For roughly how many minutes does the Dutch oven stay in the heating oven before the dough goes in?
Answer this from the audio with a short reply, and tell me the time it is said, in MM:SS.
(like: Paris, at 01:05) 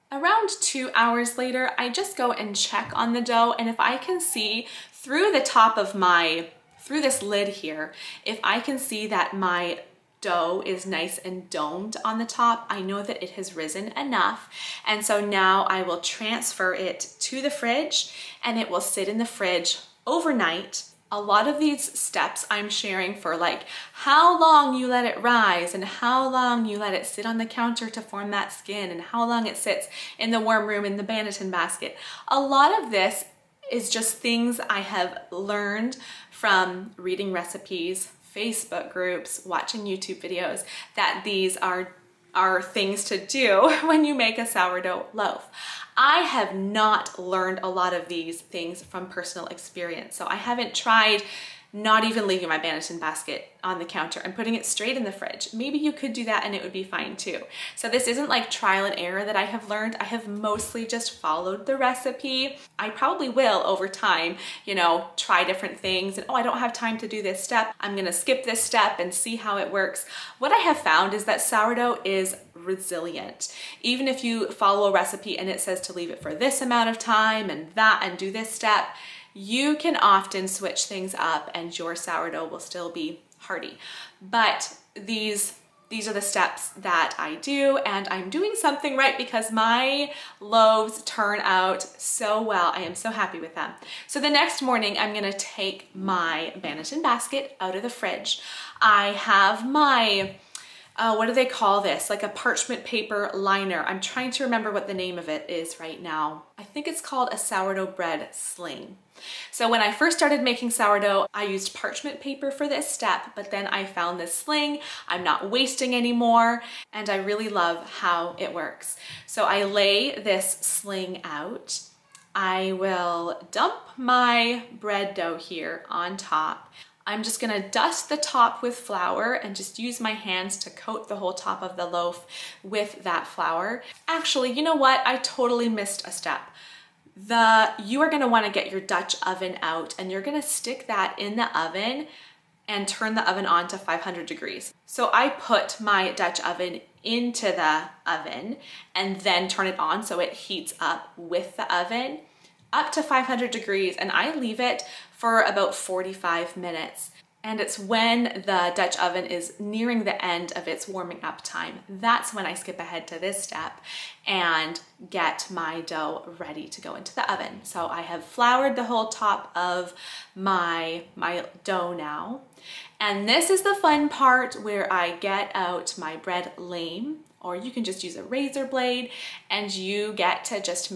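45, at 02:35.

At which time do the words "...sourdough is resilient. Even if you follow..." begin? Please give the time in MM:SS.
01:11.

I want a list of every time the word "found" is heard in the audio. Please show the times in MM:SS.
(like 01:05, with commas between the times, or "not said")
01:10, 01:53.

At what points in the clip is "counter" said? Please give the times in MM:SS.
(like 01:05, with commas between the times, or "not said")
00:27, 00:53.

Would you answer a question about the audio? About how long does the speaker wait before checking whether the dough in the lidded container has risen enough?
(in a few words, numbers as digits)
2 hours.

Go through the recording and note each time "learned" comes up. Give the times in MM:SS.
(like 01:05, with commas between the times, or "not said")
00:35, 00:47, 00:59.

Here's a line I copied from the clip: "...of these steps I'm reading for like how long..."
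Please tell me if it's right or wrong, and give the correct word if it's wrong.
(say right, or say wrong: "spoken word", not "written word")
wrong: "sharing", not "reading".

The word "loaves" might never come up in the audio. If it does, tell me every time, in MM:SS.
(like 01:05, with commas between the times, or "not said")
01:30.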